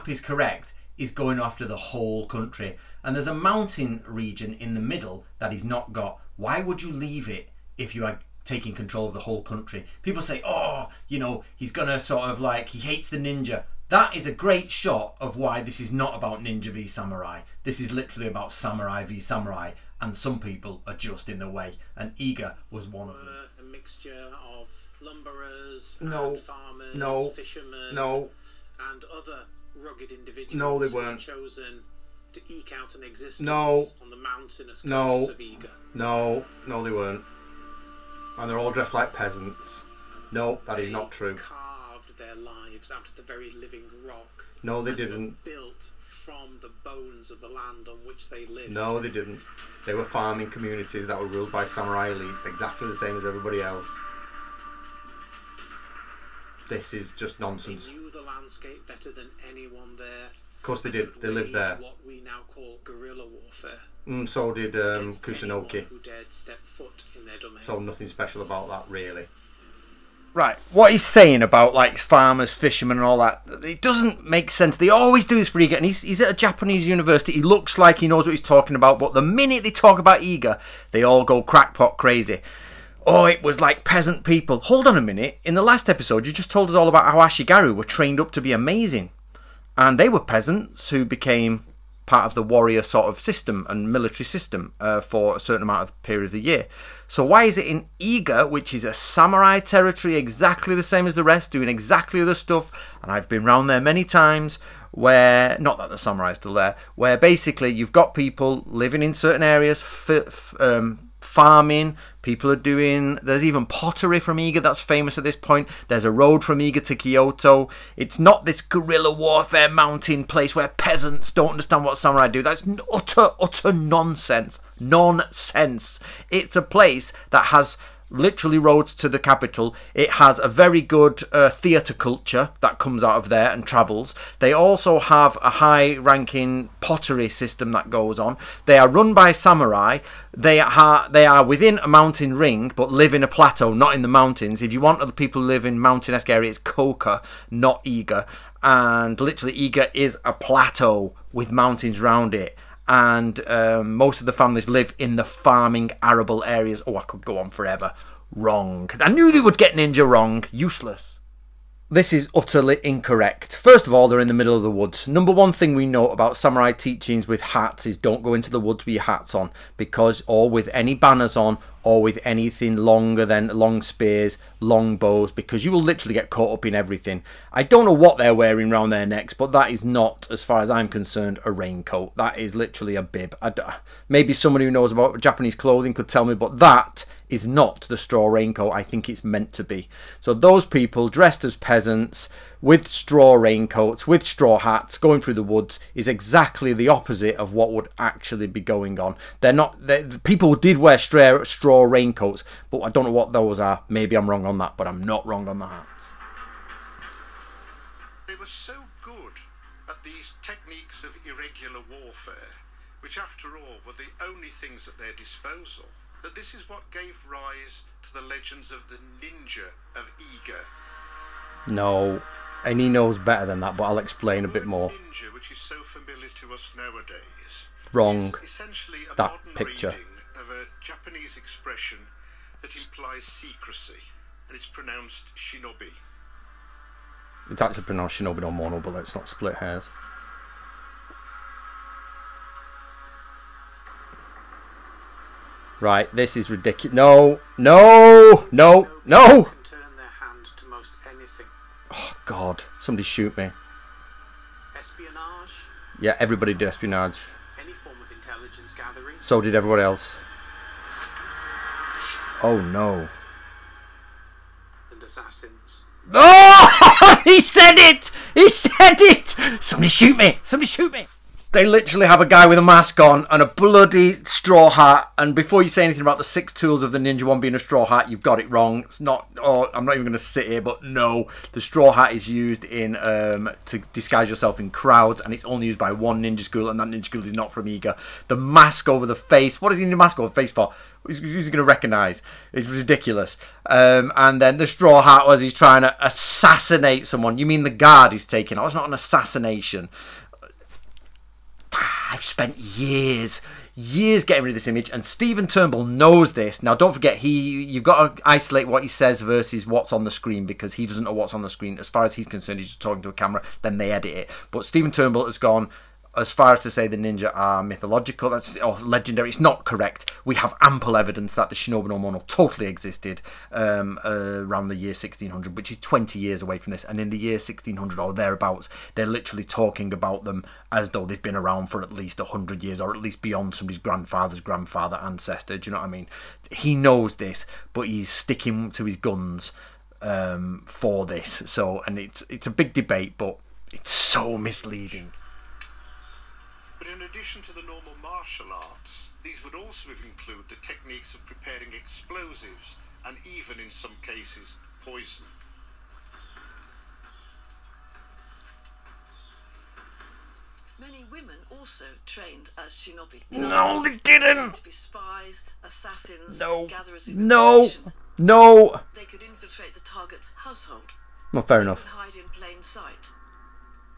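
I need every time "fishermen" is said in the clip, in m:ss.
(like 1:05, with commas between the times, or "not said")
0:27, 1:12.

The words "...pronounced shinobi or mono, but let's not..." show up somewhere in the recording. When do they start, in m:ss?
3:57.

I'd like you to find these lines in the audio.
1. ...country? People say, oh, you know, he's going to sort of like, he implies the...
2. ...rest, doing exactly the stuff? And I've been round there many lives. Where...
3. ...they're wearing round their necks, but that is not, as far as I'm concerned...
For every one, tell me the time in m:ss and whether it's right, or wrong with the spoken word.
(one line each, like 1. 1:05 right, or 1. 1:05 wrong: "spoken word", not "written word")
1. 0:09 wrong: "hates", not "implies"
2. 1:41 wrong: "times", not "lives"
3. 2:58 right.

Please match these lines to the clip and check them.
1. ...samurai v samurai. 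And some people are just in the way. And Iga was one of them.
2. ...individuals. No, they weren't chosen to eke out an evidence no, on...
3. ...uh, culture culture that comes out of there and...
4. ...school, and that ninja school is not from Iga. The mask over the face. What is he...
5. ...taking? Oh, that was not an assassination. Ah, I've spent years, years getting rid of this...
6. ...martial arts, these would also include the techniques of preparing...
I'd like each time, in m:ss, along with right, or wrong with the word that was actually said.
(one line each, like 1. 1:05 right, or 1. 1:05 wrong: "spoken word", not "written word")
1. 0:18 right
2. 0:30 wrong: "existence", not "evidence"
3. 2:11 wrong: "theatre", not "culture"
4. 4:46 right
5. 4:58 right
6. 5:48 right.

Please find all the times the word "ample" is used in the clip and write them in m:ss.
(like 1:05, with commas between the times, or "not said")
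5:20.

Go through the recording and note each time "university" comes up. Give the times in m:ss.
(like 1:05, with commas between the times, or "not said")
1:16.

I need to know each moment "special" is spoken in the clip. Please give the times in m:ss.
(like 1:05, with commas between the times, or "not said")
1:08.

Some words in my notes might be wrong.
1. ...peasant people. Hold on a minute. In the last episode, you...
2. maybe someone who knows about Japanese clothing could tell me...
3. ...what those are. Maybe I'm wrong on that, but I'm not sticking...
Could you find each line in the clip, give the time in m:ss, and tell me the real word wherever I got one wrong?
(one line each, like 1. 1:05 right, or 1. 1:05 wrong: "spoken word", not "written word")
1. 1:23 right
2. 3:04 right
3. 3:23 wrong: "wrong", not "sticking".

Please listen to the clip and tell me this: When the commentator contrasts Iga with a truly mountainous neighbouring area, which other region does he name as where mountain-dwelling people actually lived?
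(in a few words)
Koka.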